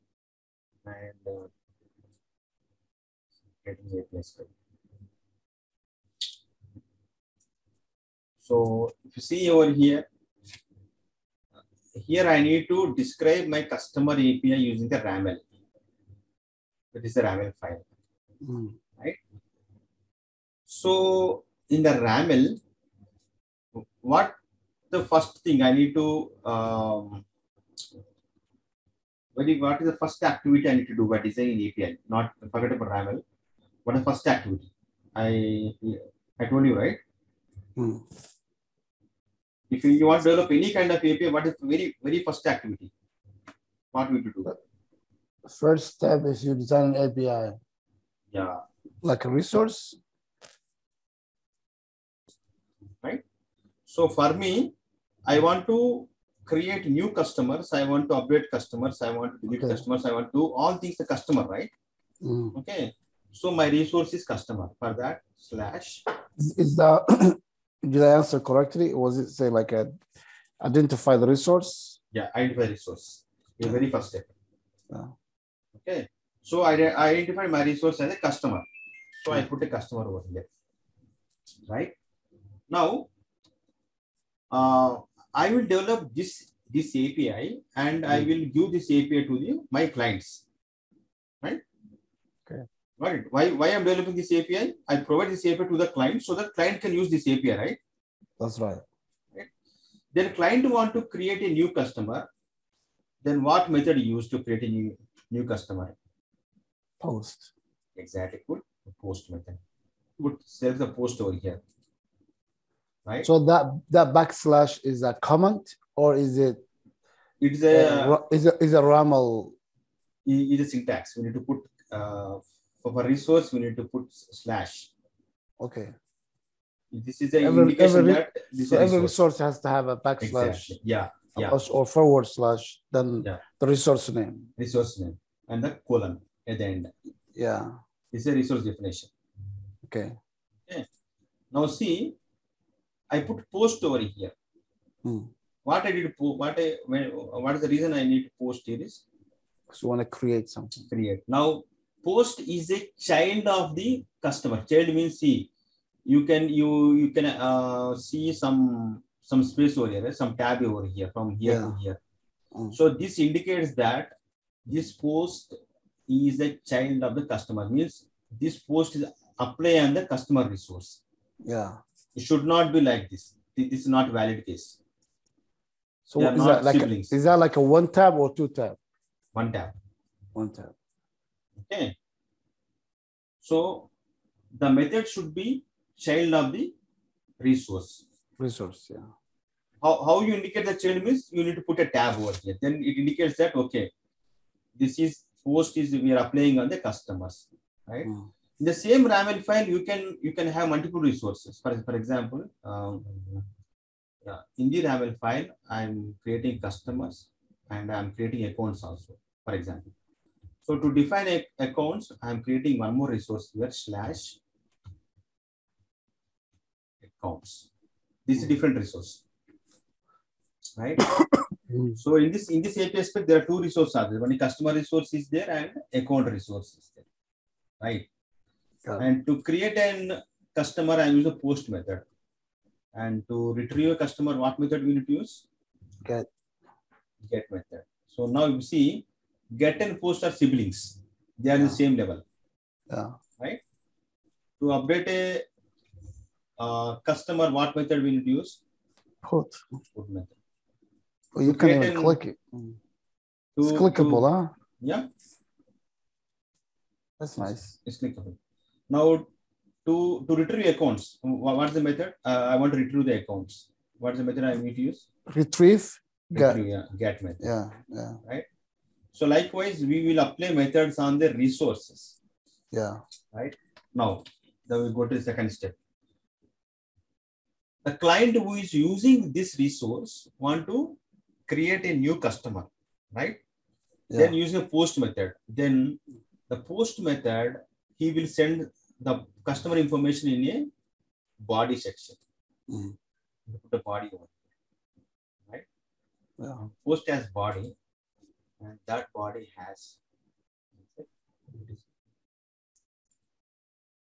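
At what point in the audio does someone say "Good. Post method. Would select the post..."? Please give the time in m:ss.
1:48.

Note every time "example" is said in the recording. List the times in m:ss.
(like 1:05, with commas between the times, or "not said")
3:21, 3:29.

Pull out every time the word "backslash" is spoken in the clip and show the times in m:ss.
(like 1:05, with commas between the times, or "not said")
1:54, 2:09.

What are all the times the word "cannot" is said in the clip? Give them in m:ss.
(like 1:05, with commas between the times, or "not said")
not said.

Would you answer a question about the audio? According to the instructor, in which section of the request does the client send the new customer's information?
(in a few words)
body section.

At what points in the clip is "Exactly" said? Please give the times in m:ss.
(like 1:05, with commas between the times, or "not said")
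1:47, 2:10.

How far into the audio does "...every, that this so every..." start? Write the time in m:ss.
2:07.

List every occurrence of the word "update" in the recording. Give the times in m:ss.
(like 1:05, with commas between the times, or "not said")
0:58, 4:04.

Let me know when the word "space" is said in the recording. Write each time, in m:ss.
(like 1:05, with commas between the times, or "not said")
2:39.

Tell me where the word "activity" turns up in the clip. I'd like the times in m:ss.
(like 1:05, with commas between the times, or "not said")
0:30, 0:34, 0:42.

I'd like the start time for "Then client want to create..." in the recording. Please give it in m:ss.
1:40.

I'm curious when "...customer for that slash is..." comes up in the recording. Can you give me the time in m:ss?
1:04.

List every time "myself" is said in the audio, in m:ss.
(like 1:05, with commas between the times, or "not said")
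not said.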